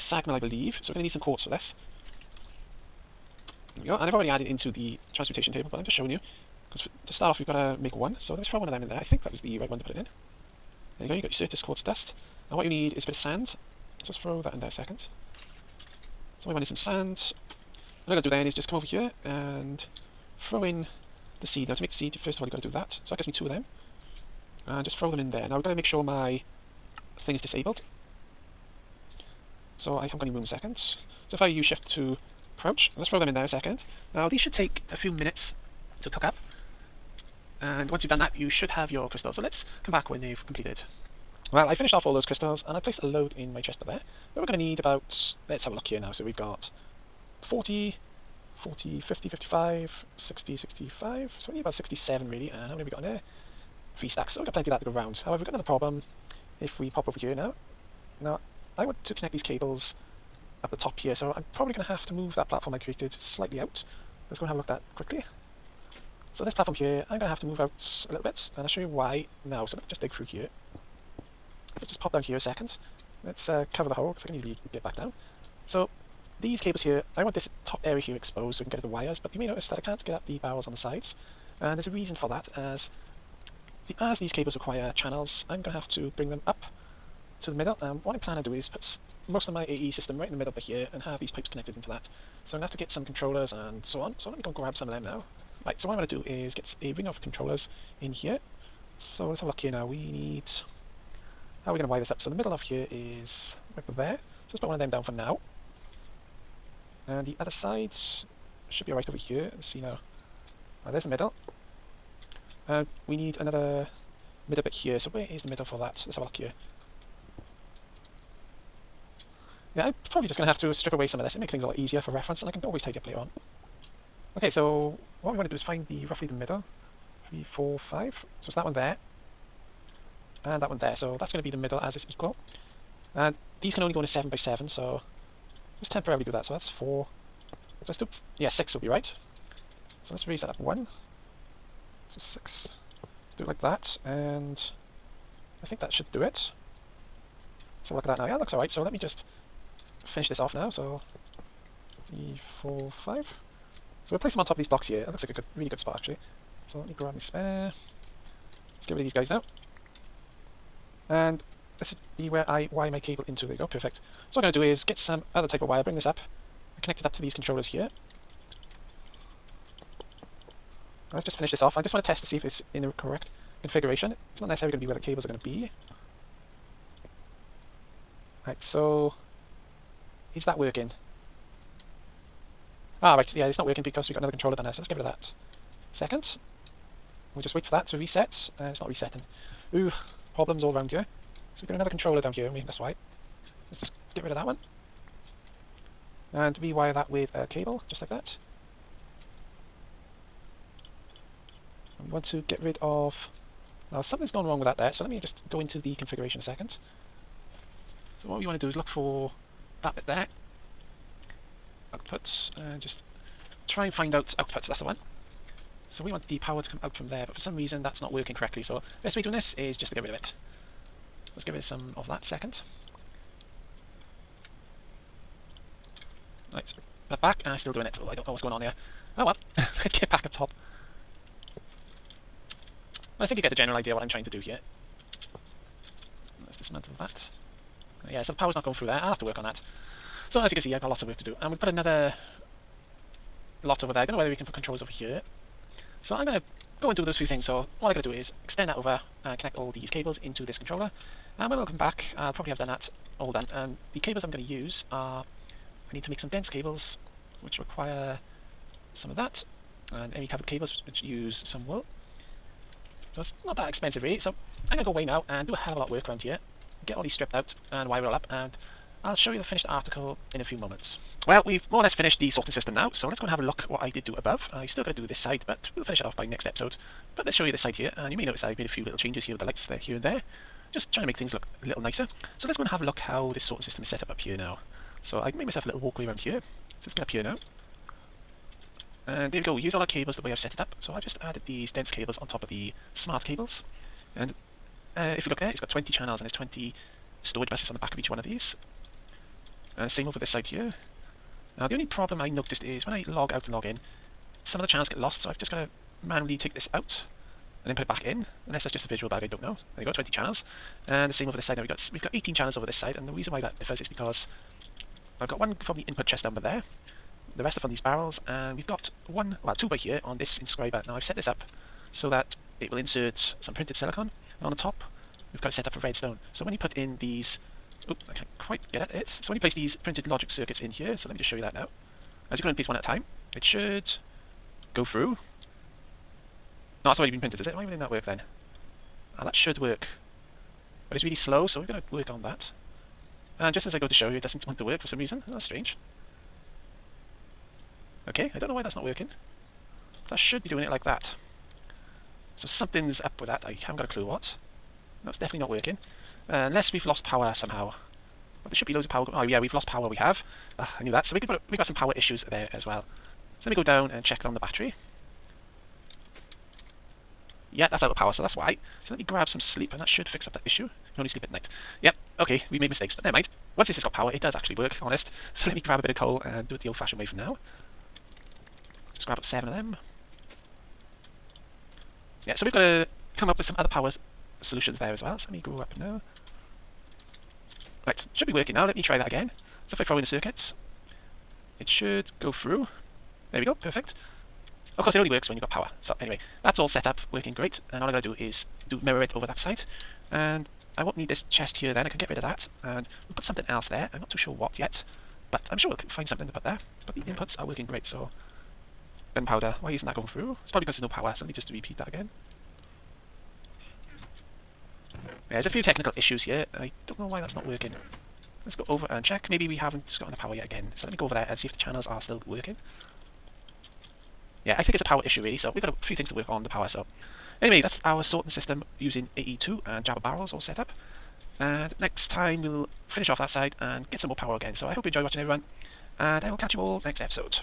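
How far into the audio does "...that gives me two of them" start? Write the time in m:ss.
0:23.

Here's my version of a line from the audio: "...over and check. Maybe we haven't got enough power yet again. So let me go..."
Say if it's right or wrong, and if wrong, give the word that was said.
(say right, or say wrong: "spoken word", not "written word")
right.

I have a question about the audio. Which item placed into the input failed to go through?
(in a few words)
gunpowder.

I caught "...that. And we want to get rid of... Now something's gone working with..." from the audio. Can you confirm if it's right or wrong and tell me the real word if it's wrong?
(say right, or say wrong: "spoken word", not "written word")
wrong: "wrong", not "working".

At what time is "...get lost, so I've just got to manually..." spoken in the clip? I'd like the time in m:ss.
5:04.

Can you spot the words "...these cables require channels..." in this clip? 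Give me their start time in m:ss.
1:24.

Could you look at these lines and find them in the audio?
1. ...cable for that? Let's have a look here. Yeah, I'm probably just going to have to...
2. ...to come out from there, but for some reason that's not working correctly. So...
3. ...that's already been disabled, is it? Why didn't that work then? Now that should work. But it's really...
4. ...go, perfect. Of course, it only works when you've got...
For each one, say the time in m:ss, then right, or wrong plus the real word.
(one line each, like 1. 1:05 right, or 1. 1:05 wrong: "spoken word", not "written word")
1. 1:55 wrong: "middle", not "cable"
2. 3:36 right
3. 5:36 wrong: "printed", not "disabled"
4. 6:33 right.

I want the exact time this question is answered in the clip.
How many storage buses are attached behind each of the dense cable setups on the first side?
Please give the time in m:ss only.
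4:56.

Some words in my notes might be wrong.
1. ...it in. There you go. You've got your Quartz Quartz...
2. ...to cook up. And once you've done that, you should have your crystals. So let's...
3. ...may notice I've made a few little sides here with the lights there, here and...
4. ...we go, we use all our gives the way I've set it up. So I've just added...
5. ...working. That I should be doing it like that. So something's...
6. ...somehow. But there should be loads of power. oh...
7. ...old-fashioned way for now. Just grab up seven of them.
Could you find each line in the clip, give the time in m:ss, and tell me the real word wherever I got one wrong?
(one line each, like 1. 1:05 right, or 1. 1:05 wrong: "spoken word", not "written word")
1. 0:09 wrong: "Certus", not "Quartz"
2. 0:36 right
3. 4:38 wrong: "changes", not "sides"
4. 4:49 wrong: "cables", not "gives"
5. 5:48 right
6. 5:57 right
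7. 6:16 right.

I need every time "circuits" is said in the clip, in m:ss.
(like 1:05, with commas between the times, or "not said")
5:30, 6:30.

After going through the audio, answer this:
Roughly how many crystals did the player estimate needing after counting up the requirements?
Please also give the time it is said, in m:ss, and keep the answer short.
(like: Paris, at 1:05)
67, at 0:51.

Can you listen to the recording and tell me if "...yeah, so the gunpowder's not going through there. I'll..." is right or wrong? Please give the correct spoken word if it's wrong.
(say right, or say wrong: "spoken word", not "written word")
wrong: "power", not "gunpowder".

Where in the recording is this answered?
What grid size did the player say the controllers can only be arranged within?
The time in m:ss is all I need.
2:14.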